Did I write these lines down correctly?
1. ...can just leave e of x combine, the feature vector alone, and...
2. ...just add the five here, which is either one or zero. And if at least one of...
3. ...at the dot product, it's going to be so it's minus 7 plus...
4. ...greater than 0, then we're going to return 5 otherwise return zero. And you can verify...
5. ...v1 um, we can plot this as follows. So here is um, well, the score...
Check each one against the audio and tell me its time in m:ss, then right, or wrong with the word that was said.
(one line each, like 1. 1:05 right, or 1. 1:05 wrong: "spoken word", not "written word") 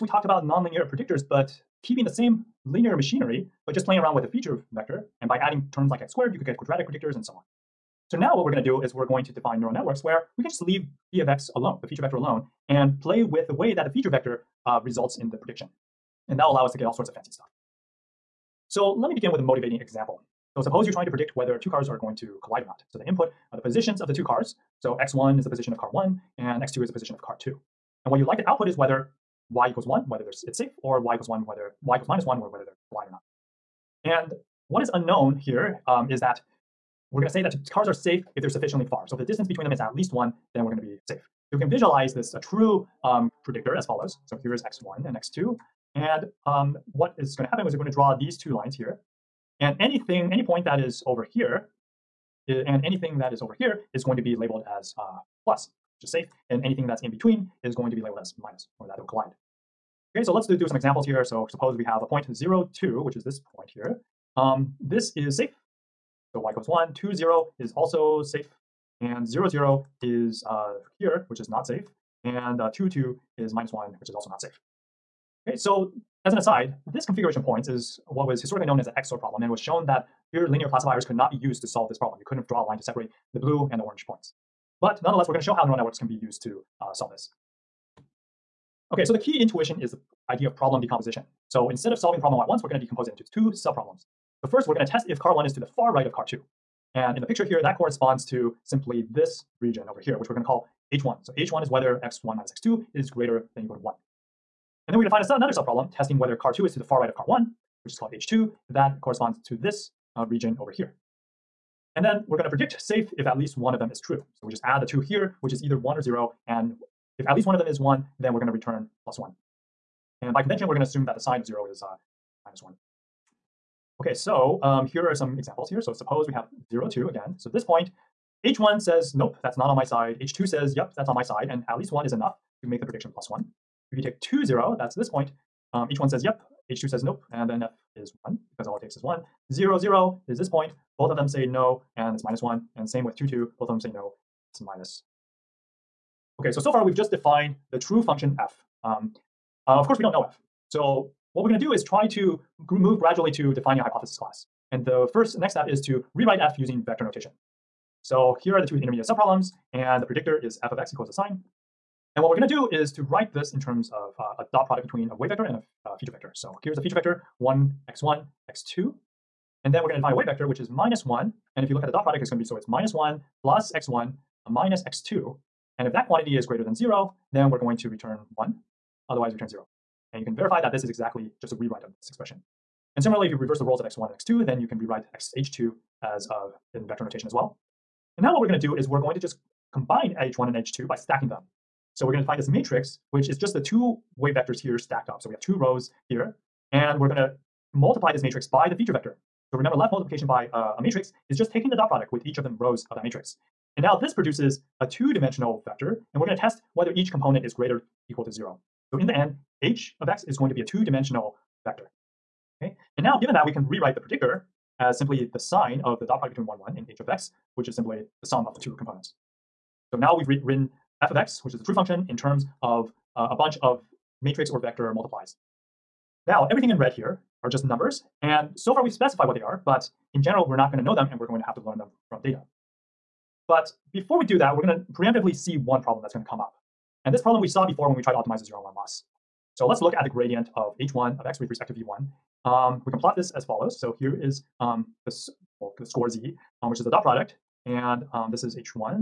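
1. 0:10 wrong: "alone", not "combine"
2. 1:54 wrong: "two", not "five"
3. 2:51 wrong: "1", not "7"
4. 2:56 wrong: "1", not "5"
5. 4:01 right.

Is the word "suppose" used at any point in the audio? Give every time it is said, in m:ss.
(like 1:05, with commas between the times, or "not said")
0:20, 1:01, 2:05.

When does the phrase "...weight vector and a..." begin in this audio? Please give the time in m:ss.
2:45.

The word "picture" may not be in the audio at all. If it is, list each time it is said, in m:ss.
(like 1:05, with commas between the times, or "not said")
1:37.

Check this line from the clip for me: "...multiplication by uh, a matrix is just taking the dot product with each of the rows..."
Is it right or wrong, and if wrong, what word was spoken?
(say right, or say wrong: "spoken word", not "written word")
right.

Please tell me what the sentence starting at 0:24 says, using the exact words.
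So x1 is the position of car 1 and x2 is the position of car 2.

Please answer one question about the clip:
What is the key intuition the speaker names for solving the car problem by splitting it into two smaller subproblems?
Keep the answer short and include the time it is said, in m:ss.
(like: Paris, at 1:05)
Problem decomposition, at 1:30.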